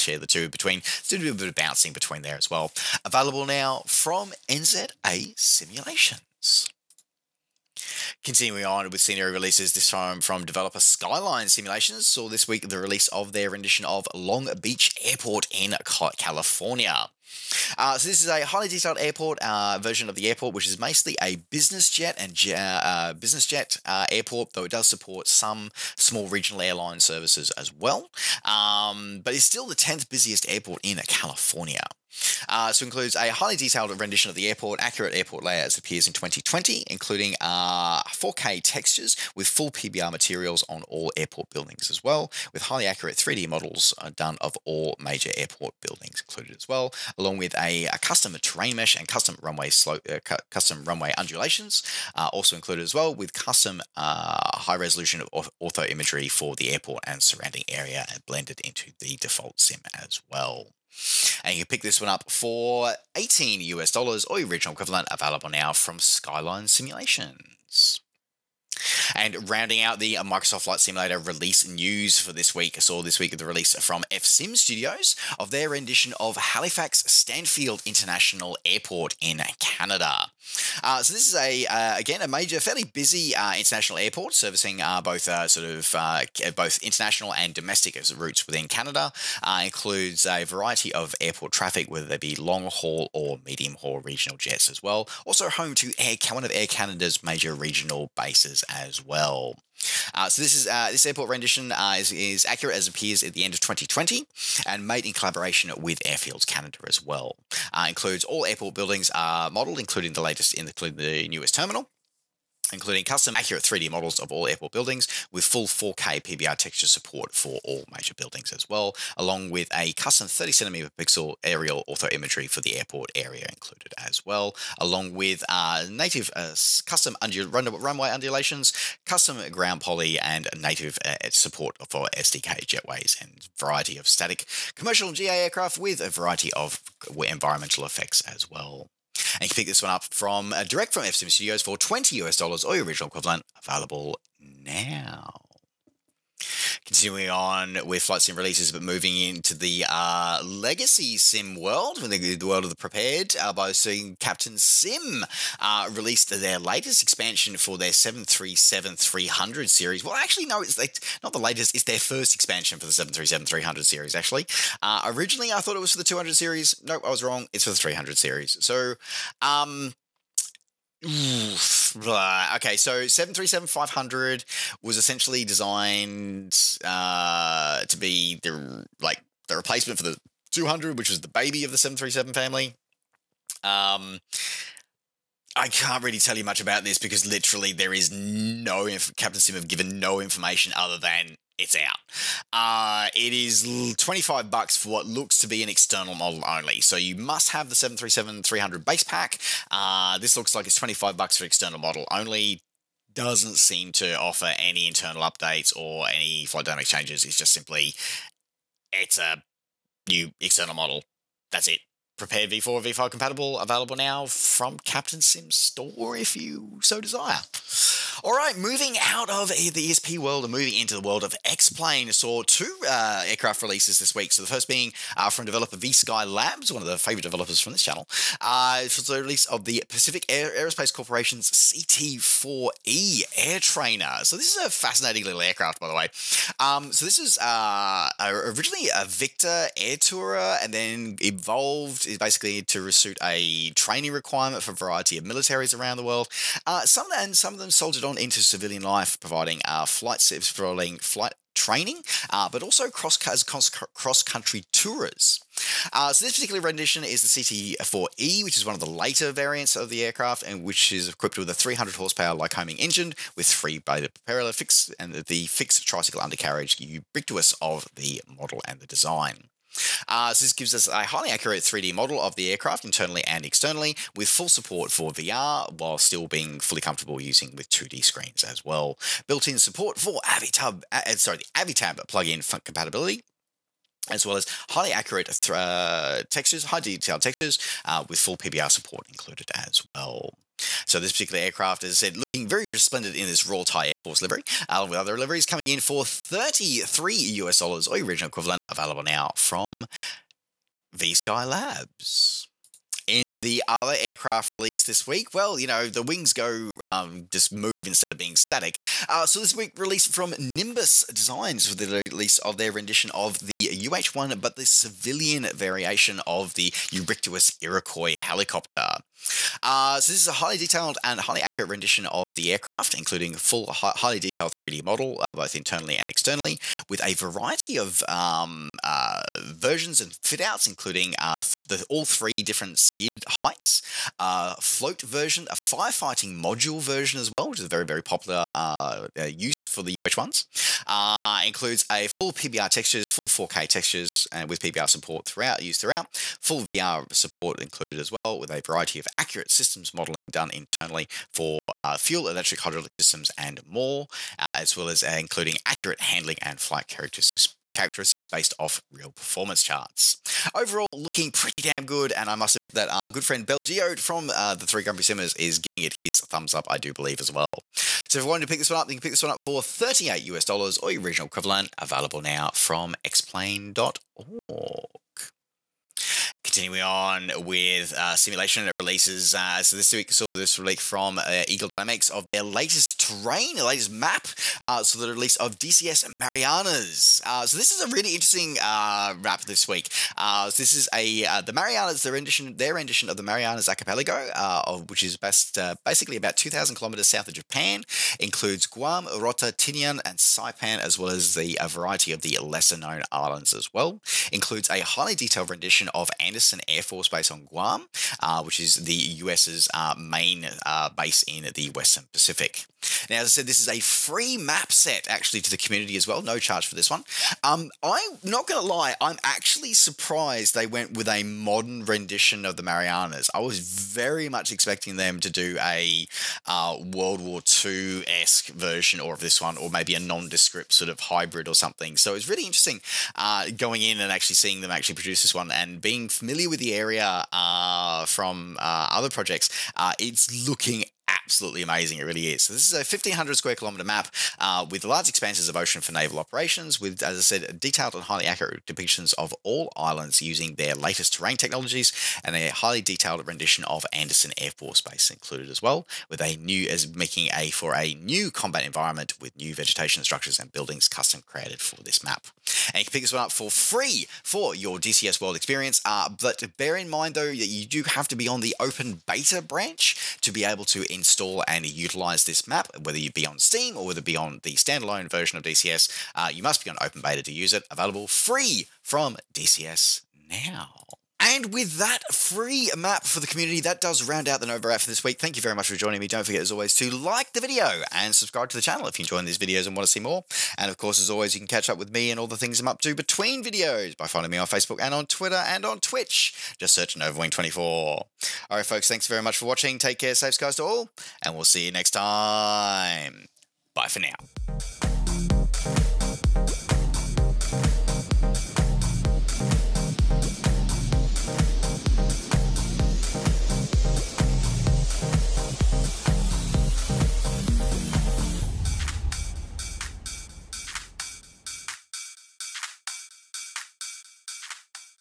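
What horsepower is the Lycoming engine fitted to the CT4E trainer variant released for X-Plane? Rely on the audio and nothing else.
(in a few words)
300.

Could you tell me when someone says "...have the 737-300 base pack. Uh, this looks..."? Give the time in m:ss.
3:17.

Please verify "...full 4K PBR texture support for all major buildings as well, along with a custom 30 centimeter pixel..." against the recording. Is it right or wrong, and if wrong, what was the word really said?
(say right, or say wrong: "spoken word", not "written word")
right.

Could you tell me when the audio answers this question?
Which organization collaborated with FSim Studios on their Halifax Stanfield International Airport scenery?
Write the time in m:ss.
1:46.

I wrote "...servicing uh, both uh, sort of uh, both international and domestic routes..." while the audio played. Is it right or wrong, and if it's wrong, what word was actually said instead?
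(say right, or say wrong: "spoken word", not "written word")
right.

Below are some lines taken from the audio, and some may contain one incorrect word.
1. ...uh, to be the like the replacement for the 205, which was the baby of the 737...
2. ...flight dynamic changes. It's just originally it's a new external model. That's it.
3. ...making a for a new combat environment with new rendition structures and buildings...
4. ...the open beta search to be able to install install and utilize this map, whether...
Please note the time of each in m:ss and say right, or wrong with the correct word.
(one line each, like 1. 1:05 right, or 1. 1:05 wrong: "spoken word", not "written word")
1. 2:56 wrong: "200", not "205"
2. 3:26 wrong: "simply", not "originally"
3. 7:36 wrong: "vegetation", not "rendition"
4. 7:48 wrong: "branch", not "search".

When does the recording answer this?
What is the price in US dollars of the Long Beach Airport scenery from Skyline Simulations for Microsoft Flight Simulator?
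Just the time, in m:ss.
1:03.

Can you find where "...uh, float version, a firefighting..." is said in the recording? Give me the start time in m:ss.
5:34.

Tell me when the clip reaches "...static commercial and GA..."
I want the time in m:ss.
2:14.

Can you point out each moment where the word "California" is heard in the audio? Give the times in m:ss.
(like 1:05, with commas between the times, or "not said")
0:16, 0:31.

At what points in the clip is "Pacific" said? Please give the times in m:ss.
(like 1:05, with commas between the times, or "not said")
3:49, 6:52.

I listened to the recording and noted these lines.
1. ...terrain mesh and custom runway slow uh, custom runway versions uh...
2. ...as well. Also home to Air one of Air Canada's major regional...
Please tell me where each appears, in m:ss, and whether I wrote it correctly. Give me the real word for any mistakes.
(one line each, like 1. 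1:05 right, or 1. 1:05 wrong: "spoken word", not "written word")
1. 0:48 wrong: "undulations", not "versions"
2. 1:34 right.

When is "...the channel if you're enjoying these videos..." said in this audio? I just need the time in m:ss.
8:08.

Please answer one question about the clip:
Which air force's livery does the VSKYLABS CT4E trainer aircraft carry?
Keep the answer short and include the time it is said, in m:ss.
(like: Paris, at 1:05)
Royal Thai Air Force, at 4:53.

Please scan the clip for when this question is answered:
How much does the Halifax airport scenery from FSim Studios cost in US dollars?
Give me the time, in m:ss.
2:21.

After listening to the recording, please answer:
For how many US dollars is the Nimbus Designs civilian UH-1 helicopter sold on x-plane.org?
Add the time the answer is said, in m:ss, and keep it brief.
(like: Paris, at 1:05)
38, at 6:09.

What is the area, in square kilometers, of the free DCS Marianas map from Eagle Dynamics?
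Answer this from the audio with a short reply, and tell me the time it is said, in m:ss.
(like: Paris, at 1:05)
1,500, at 7:22.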